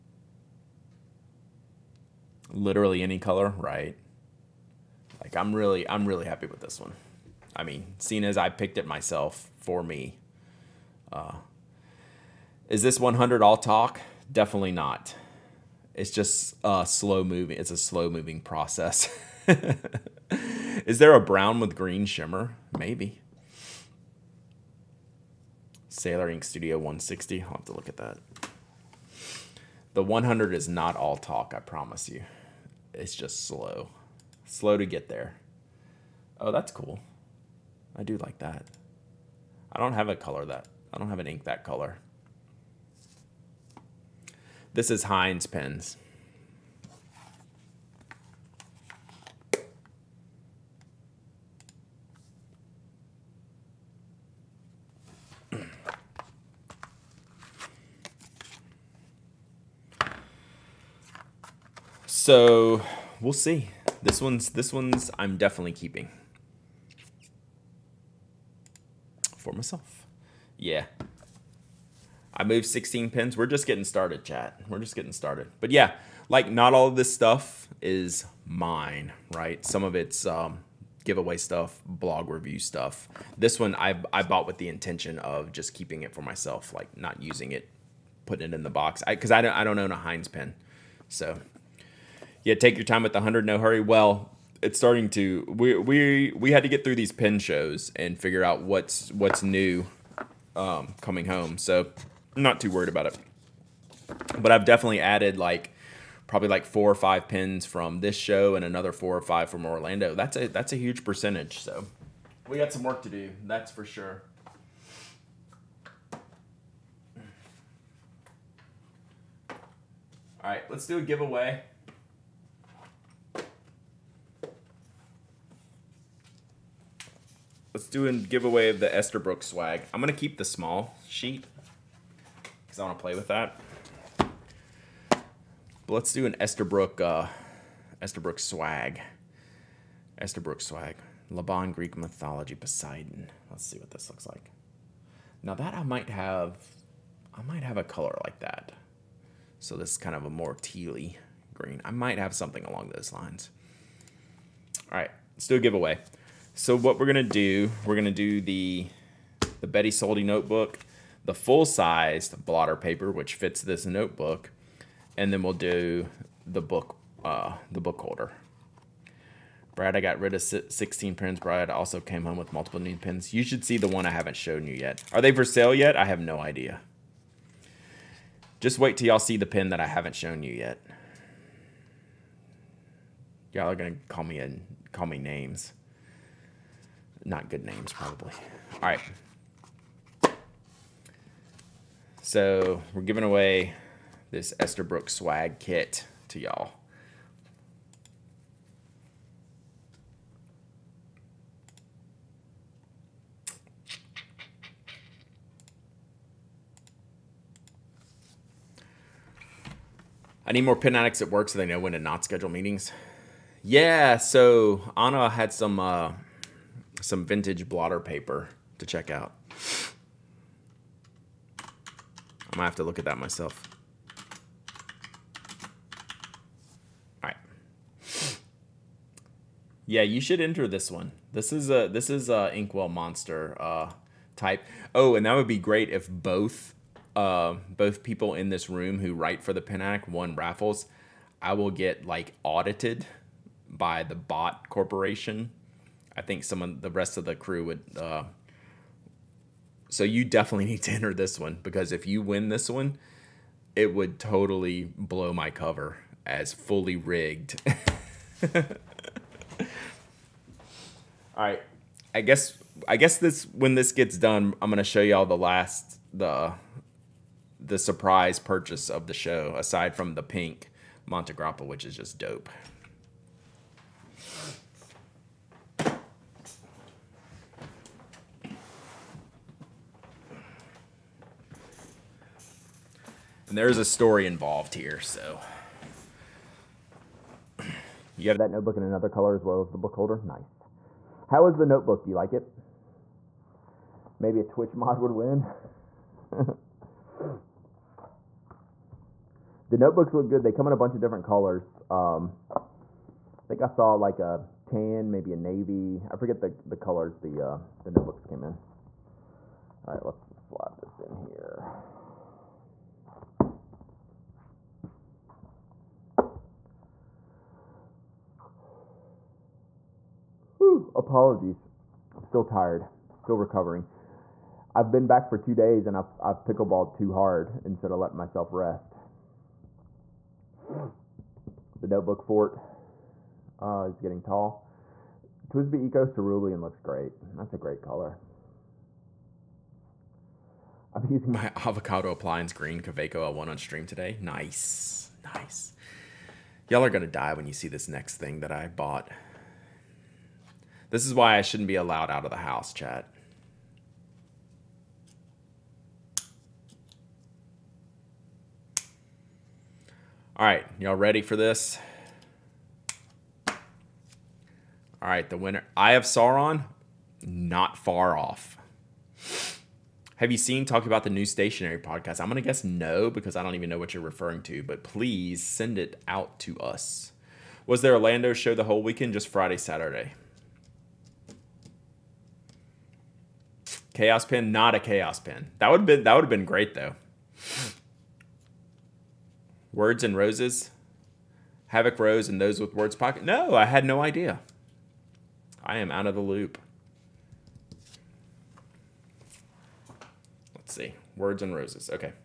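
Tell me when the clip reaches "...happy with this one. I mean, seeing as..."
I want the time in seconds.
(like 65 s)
6 s.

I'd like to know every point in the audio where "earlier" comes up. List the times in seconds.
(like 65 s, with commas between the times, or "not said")
not said.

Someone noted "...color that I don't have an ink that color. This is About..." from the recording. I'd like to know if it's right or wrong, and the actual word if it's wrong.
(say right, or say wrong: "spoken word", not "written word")
wrong: "Heinz", not "About".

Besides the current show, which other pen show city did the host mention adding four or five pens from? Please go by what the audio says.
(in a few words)
Orlando.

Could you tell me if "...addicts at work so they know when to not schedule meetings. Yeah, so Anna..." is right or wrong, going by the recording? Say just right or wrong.
right.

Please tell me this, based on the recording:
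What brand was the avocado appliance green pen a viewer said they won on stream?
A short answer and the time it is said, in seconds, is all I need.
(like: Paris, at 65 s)
Kaweco, at 342 s.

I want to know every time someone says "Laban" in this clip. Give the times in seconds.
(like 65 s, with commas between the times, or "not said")
141 s.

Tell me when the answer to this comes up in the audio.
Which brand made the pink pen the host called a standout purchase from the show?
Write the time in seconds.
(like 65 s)
271 s.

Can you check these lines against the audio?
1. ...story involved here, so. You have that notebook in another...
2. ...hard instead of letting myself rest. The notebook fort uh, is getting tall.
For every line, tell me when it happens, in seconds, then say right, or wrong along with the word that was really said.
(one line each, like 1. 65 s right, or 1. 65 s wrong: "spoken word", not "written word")
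1. 283 s right
2. 327 s right.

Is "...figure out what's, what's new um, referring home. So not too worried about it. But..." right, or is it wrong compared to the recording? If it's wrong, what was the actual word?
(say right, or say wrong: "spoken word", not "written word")
wrong: "coming", not "referring".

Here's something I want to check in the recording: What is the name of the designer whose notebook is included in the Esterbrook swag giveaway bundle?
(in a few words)
Betty Soldi.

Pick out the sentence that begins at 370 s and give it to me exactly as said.
Have you seen Talk About the New Stationary podcast?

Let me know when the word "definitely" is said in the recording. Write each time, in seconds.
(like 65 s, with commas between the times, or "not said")
14 s, 65 s, 104 s, 250 s.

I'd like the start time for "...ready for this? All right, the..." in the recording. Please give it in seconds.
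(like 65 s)
360 s.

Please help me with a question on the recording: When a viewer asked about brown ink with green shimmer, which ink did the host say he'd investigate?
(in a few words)
Sailor Ink Studio 160.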